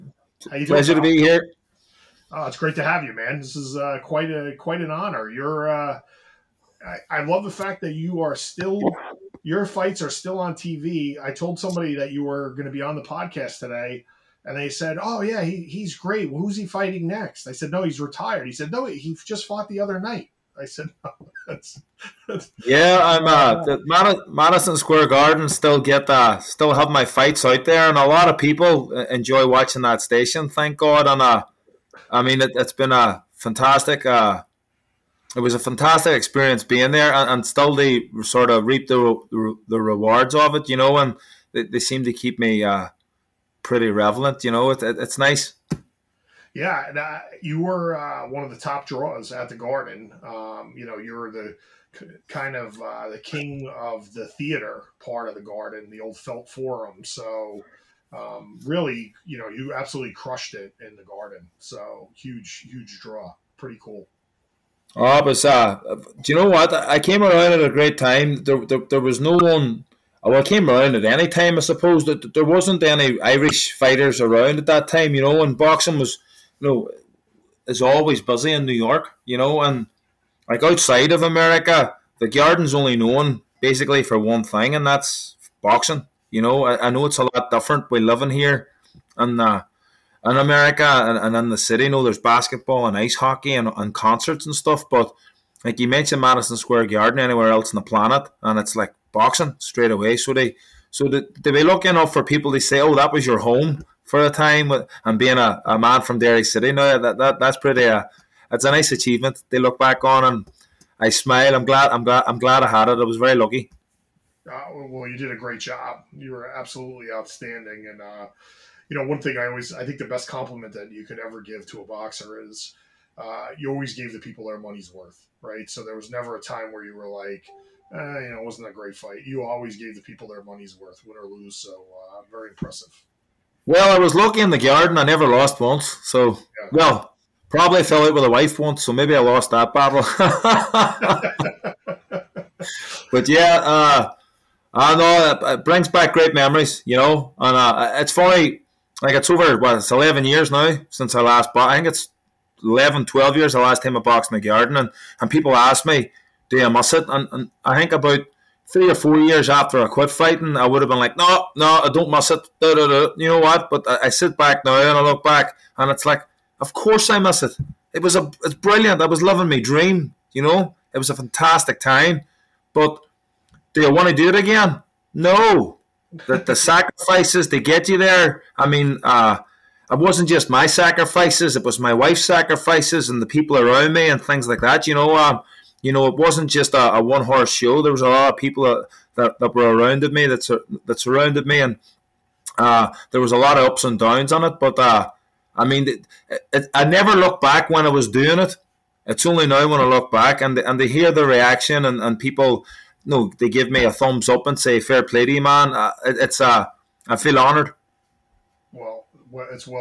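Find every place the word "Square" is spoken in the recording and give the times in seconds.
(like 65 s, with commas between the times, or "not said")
24 s, 96 s.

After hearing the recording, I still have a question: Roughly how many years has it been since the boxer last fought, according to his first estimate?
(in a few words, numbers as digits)
11.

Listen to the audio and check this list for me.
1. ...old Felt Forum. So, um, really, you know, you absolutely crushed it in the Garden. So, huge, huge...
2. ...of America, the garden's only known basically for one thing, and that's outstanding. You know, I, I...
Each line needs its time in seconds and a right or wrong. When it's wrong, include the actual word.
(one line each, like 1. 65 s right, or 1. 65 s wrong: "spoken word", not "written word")
1. 55 s right
2. 81 s wrong: "boxing", not "outstanding".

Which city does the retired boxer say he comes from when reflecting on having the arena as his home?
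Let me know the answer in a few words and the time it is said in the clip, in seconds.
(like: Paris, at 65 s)
Derry, at 106 s.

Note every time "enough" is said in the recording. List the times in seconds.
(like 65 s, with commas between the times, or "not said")
101 s.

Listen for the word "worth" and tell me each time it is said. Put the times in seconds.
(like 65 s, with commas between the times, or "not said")
124 s, 130 s.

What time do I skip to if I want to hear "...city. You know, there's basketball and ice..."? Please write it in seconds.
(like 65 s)
91 s.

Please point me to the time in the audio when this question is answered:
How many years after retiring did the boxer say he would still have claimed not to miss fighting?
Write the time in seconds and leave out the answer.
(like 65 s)
158 s.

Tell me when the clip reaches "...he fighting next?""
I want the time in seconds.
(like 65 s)
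16 s.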